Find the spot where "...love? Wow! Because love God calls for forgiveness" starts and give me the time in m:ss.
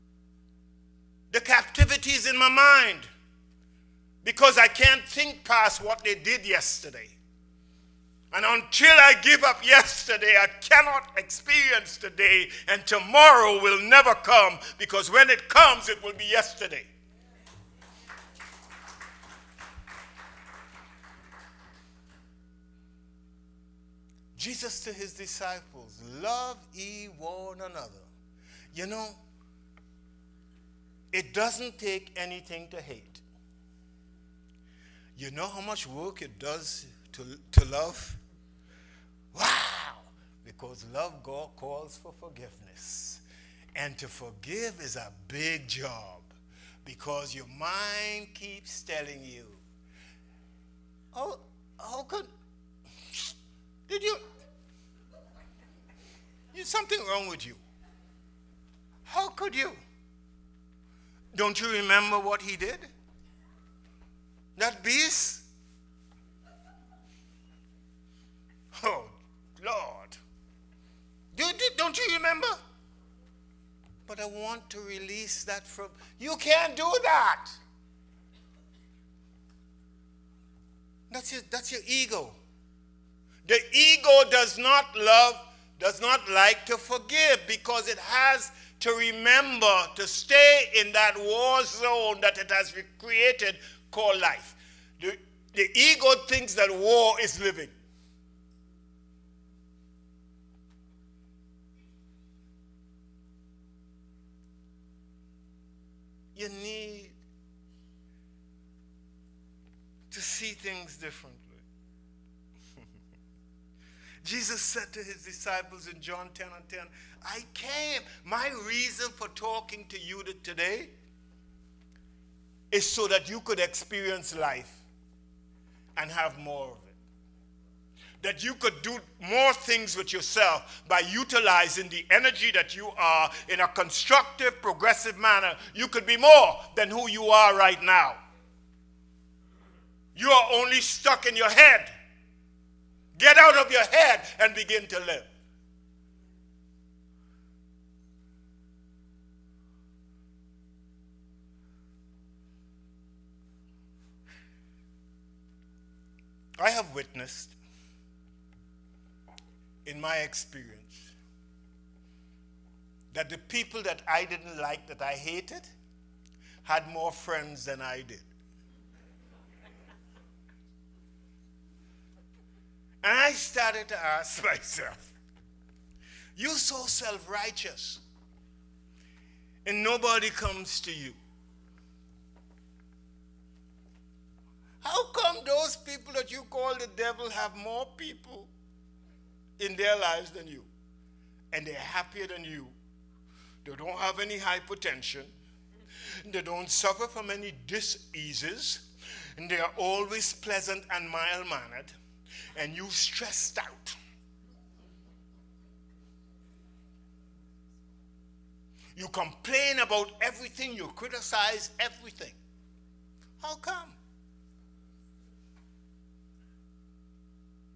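0:37.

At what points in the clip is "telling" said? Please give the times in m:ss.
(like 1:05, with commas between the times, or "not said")
0:48.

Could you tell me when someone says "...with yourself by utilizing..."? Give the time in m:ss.
2:09.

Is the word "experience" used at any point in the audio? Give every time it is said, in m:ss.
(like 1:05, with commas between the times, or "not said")
0:11, 2:03, 2:40.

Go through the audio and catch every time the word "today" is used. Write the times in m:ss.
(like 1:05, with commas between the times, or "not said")
0:11, 2:00.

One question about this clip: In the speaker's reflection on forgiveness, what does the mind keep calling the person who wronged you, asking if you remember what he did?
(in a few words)
That beast.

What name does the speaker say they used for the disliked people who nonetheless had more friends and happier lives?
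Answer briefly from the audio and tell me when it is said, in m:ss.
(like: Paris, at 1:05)
the devil, at 3:06.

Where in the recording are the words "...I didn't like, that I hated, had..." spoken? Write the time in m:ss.
2:44.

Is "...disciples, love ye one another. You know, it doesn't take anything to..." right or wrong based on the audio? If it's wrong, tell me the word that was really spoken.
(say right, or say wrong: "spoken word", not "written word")
right.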